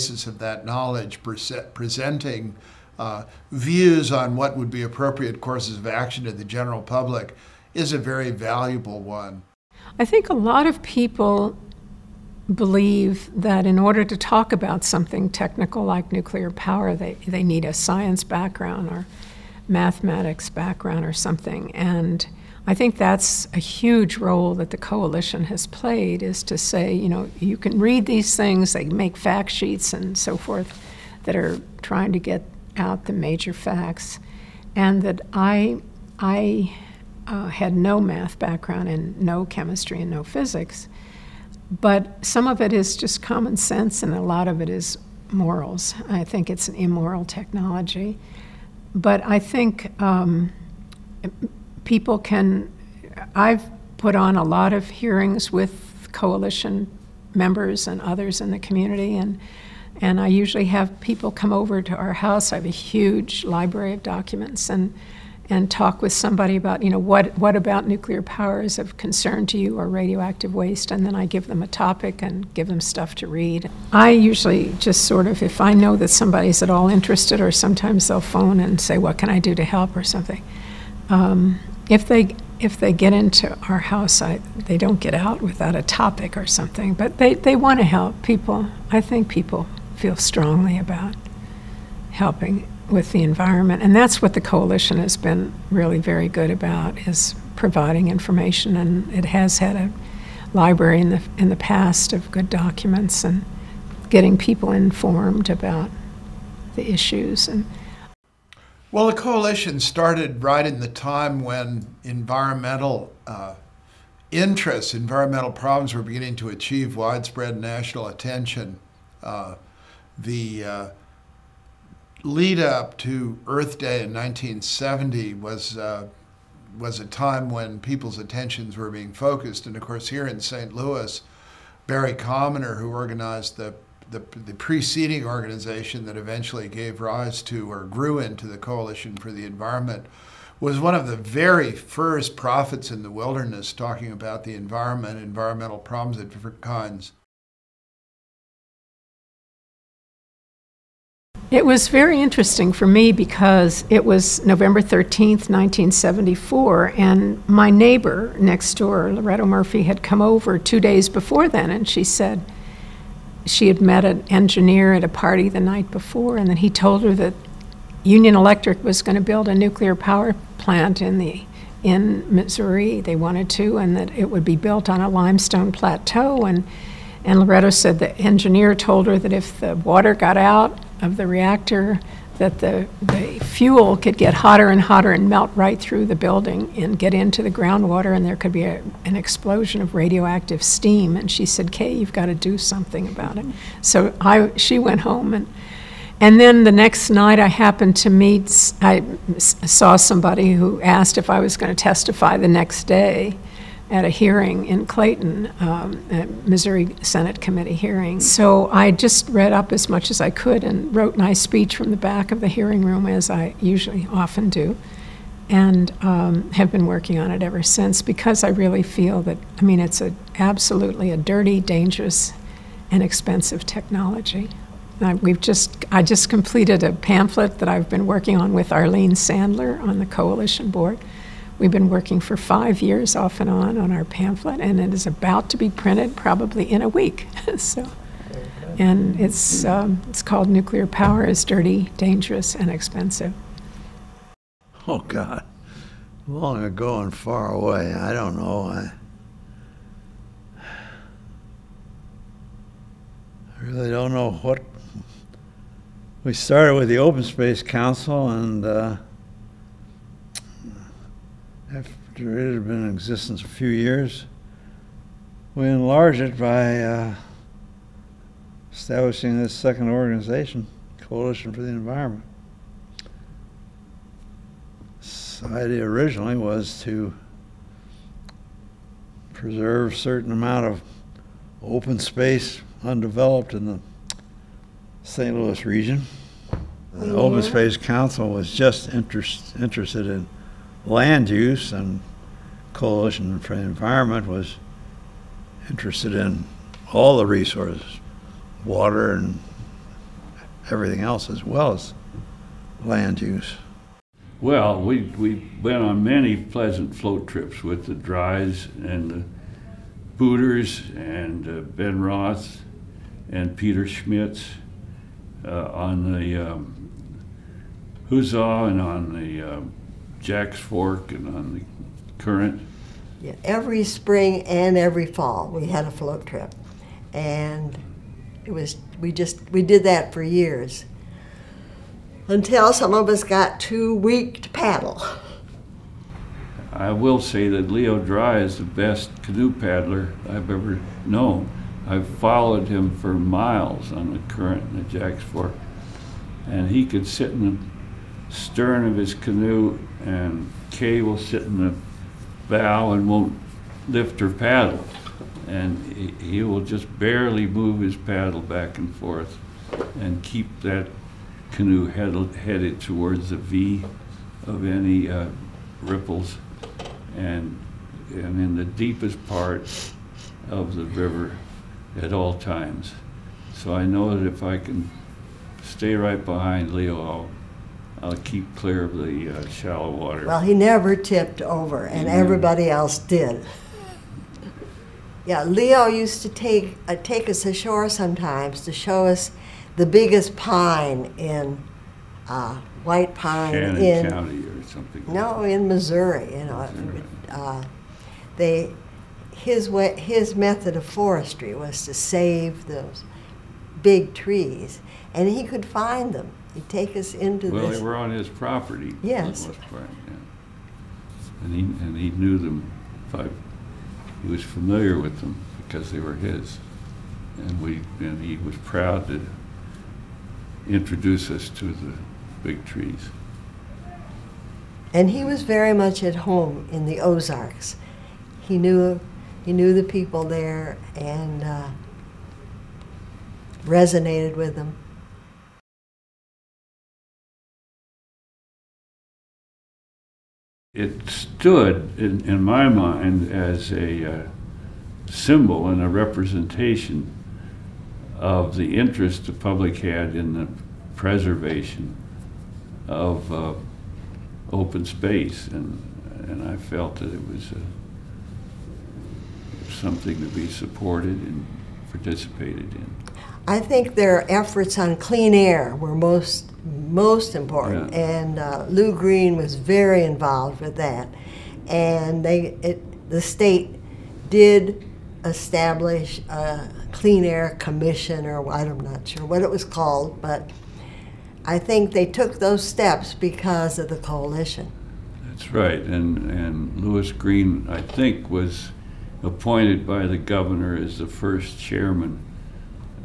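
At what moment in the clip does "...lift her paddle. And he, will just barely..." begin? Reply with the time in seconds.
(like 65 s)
353 s.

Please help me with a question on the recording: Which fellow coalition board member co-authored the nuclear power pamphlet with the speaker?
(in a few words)
Arlene Sandler.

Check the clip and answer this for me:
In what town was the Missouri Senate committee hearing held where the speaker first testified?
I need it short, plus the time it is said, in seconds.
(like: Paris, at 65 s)
Clayton, at 204 s.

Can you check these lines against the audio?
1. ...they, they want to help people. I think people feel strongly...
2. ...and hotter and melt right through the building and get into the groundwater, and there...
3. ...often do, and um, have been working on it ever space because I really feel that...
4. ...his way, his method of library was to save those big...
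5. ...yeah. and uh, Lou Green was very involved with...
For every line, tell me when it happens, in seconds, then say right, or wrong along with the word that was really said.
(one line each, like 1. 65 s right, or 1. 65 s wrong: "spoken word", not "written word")
1. 87 s right
2. 184 s right
3. 214 s wrong: "since", not "space"
4. 399 s wrong: "forestry", not "library"
5. 467 s right.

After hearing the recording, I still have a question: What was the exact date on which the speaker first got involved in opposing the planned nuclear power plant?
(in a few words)
November 13th, 1974.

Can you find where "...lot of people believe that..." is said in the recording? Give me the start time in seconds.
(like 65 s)
10 s.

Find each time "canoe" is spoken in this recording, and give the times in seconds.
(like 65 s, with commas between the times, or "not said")
339 s, 349 s, 361 s.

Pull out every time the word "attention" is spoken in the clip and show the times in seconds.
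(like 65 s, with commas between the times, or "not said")
118 s, 128 s.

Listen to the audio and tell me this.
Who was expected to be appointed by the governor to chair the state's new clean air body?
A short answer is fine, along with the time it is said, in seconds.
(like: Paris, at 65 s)
Louis Green, at 486 s.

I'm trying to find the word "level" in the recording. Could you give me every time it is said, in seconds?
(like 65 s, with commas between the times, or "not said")
not said.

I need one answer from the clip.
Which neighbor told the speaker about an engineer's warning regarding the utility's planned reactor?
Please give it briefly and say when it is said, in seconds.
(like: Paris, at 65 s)
Loretta Murphy, at 159 s.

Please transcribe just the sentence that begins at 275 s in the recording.
The idea originally was to preserve a certain amount of open space undeveloped in the St.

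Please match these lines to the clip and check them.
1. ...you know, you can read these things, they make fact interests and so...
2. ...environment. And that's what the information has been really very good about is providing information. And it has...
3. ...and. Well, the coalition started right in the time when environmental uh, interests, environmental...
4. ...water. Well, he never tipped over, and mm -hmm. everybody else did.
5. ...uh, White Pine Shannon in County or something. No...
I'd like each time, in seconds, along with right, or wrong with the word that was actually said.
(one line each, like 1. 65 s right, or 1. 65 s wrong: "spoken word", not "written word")
1. 26 s wrong: "sheets", not "interests"
2. 93 s wrong: "coalition", not "information"
3. 107 s right
4. 379 s right
5. 392 s right.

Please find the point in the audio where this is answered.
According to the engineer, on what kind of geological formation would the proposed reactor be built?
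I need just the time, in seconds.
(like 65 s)
175 s.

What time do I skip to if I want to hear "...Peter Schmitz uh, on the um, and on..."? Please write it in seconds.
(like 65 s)
313 s.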